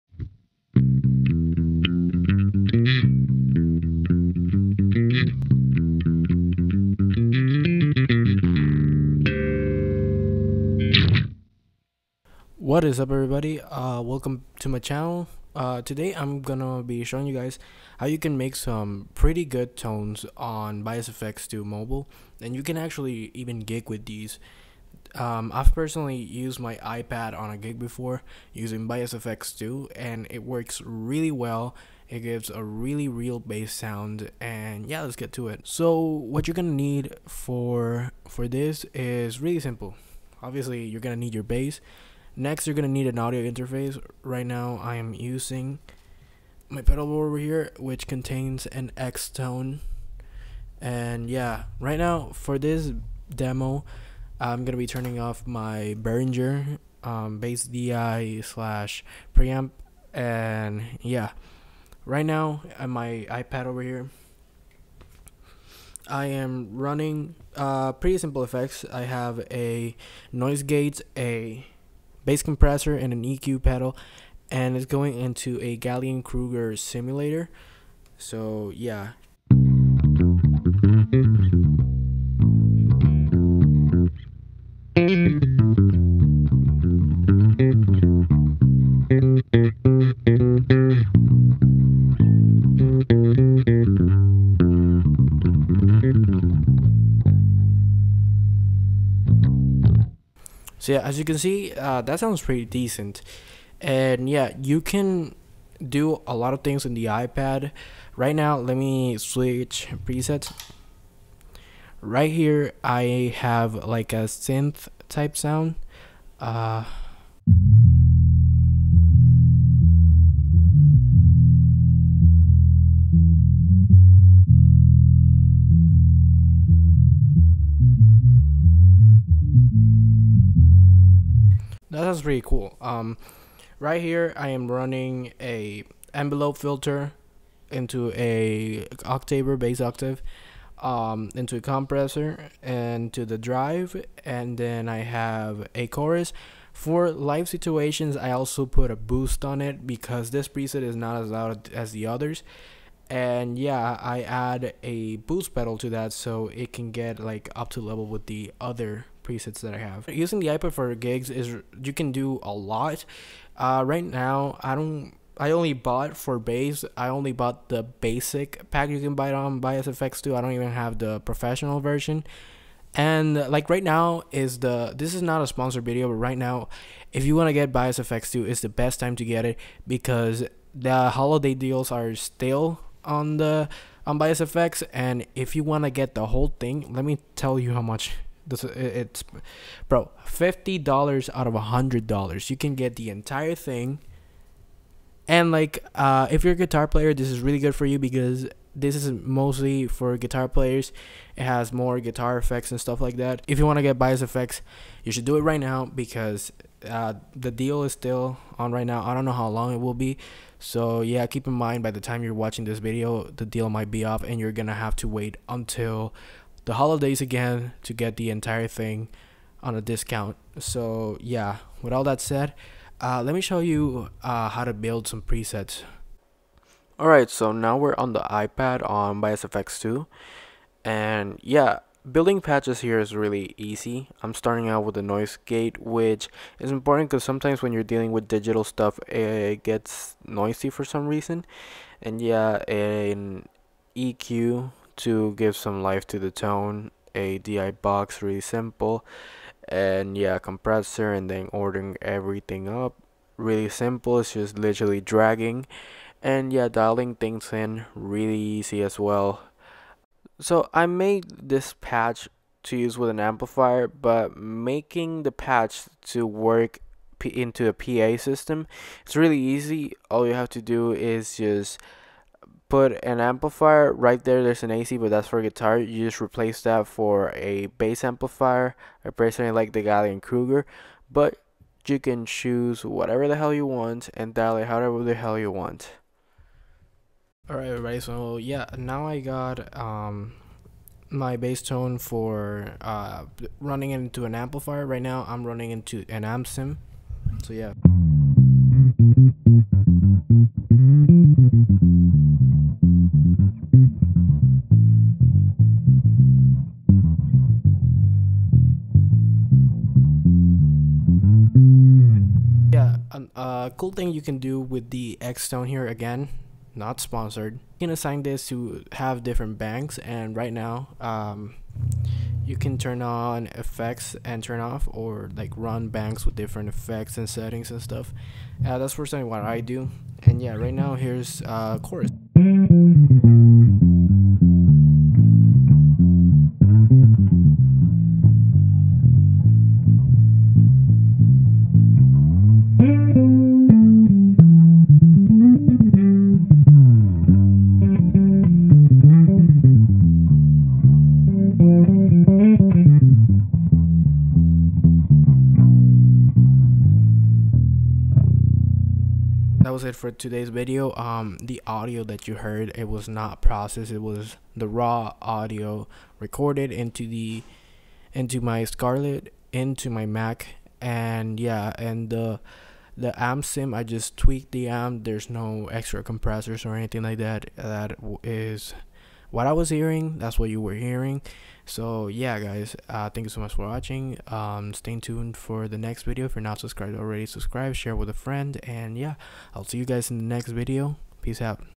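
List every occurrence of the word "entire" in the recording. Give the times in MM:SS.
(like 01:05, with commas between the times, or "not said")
03:13, 03:38.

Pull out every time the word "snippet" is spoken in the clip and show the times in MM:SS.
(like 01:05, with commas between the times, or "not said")
not said.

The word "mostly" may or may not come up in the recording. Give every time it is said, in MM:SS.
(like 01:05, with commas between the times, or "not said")
03:19.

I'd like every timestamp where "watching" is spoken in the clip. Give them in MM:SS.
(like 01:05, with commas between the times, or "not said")
03:32, 06:23.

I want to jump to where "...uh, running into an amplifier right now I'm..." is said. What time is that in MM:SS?
04:52.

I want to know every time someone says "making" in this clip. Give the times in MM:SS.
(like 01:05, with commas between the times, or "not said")
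04:24.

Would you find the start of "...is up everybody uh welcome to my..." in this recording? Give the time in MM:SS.
00:12.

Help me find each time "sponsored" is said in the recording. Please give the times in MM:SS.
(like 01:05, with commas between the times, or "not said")
02:55, 05:16.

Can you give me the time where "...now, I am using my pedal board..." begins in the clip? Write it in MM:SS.
00:44.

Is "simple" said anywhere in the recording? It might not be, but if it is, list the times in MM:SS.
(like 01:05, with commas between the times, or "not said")
00:39, 01:08, 04:08, 04:13.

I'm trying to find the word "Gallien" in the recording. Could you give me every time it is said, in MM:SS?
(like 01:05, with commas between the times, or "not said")
01:15, 04:39.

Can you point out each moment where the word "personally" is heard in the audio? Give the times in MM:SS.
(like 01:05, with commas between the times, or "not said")
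00:25, 04:39, 05:28.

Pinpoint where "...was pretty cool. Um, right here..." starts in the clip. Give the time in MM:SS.
02:12.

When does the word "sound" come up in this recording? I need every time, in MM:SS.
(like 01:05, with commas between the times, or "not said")
00:33, 01:42, 01:55.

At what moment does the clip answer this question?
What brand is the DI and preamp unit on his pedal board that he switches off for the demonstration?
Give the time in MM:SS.
00:56.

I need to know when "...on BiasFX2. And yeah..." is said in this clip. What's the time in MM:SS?
03:48.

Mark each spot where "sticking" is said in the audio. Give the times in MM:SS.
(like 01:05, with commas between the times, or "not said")
not said.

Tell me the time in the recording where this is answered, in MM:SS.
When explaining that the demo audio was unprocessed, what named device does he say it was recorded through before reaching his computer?
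06:08.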